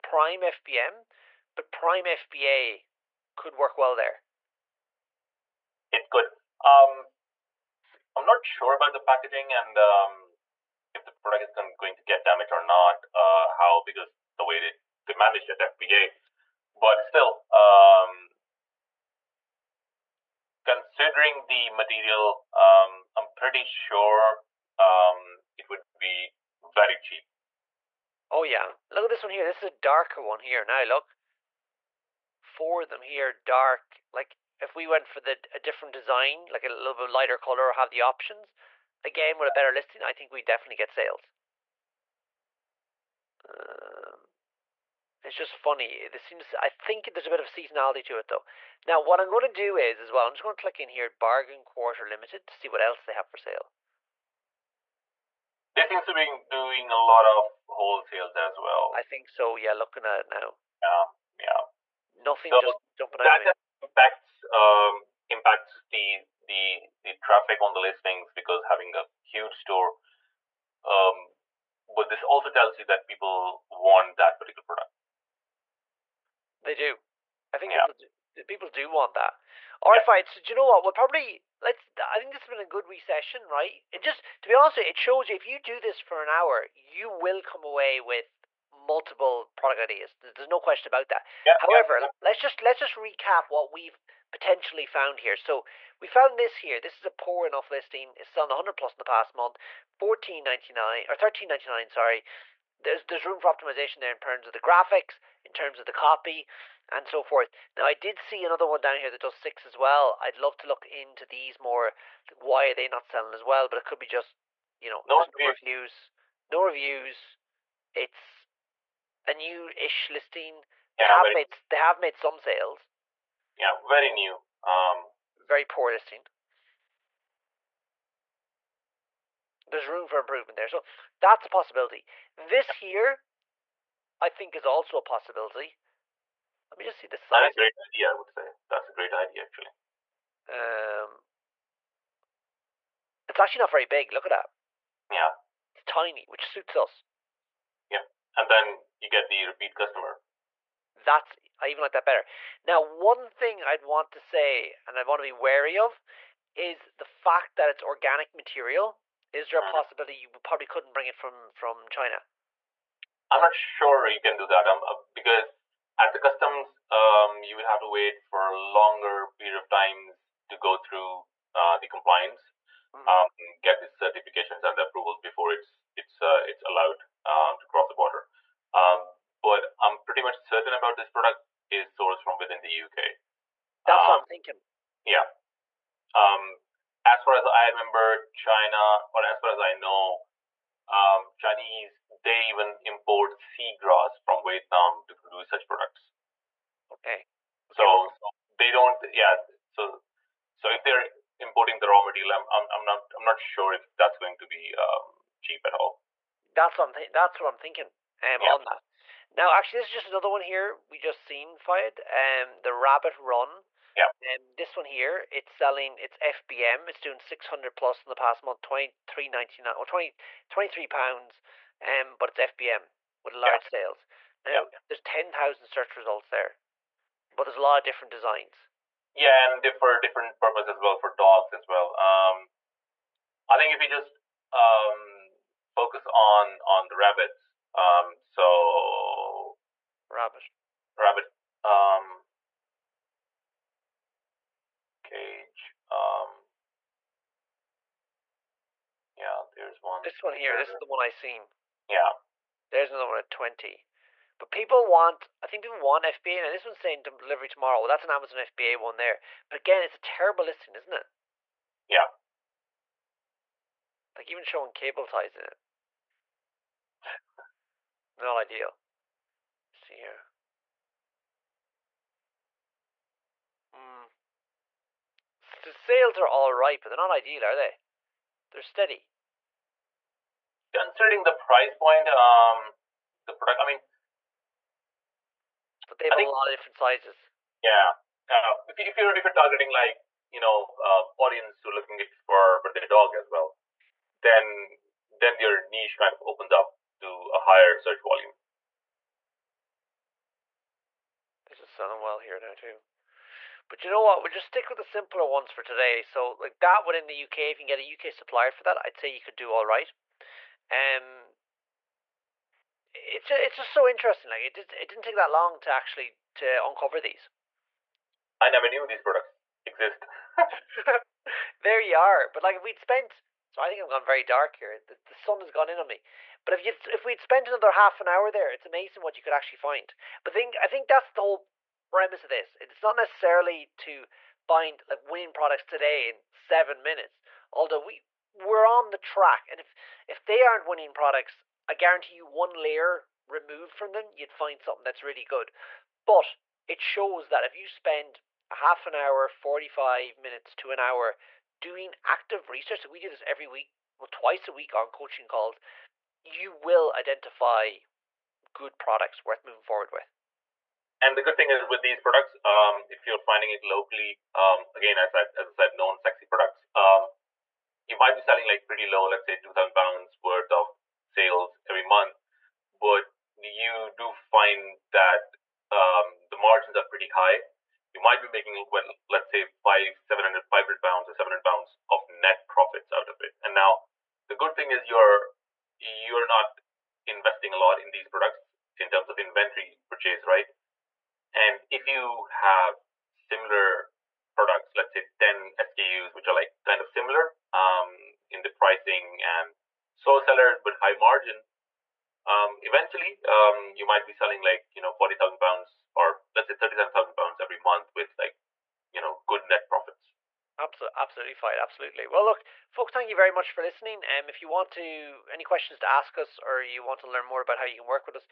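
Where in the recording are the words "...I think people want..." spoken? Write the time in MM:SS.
04:15.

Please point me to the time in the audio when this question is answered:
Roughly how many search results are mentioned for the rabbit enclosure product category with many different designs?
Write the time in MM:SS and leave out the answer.
03:45.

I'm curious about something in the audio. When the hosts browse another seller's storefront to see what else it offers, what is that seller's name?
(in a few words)
Bargain Quarter Limited.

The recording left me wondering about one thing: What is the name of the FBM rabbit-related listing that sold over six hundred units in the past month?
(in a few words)
Rabbit Run.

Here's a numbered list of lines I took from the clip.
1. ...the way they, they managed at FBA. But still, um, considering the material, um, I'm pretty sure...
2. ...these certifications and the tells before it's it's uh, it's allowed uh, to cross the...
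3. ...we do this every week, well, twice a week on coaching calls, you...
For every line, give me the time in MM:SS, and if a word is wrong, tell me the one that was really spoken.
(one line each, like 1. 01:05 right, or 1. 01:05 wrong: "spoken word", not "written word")
1. 00:14 right
2. 02:53 wrong: "approvals", not "tells"
3. 05:52 right.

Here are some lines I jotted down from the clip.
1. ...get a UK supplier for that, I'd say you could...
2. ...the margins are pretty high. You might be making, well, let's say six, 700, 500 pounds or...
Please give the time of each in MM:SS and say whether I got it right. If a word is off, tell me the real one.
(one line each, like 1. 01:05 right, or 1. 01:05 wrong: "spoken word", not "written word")
1. 05:07 right
2. 06:16 wrong: "five", not "six".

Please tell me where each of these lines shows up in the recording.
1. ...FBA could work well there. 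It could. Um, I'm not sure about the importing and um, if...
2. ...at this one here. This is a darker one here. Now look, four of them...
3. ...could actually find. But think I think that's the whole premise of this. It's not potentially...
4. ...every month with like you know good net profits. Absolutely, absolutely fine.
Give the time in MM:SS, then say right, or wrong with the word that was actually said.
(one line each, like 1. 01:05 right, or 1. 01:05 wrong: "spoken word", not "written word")
1. 00:02 wrong: "packaging", not "importing"
2. 00:29 right
3. 05:29 wrong: "necessarily", not "potentially"
4. 06:47 right.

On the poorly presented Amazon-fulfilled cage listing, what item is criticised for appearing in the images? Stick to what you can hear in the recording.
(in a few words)
cable ties.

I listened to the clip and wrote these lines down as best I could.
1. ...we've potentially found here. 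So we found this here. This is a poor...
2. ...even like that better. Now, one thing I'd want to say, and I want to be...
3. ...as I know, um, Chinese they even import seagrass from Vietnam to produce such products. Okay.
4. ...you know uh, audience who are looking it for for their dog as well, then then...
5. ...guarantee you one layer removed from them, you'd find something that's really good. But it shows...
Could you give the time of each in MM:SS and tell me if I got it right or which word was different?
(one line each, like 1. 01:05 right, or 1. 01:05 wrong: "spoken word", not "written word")
1. 01:33 right
2. 02:31 right
3. 03:09 right
4. 04:50 right
5. 05:41 right.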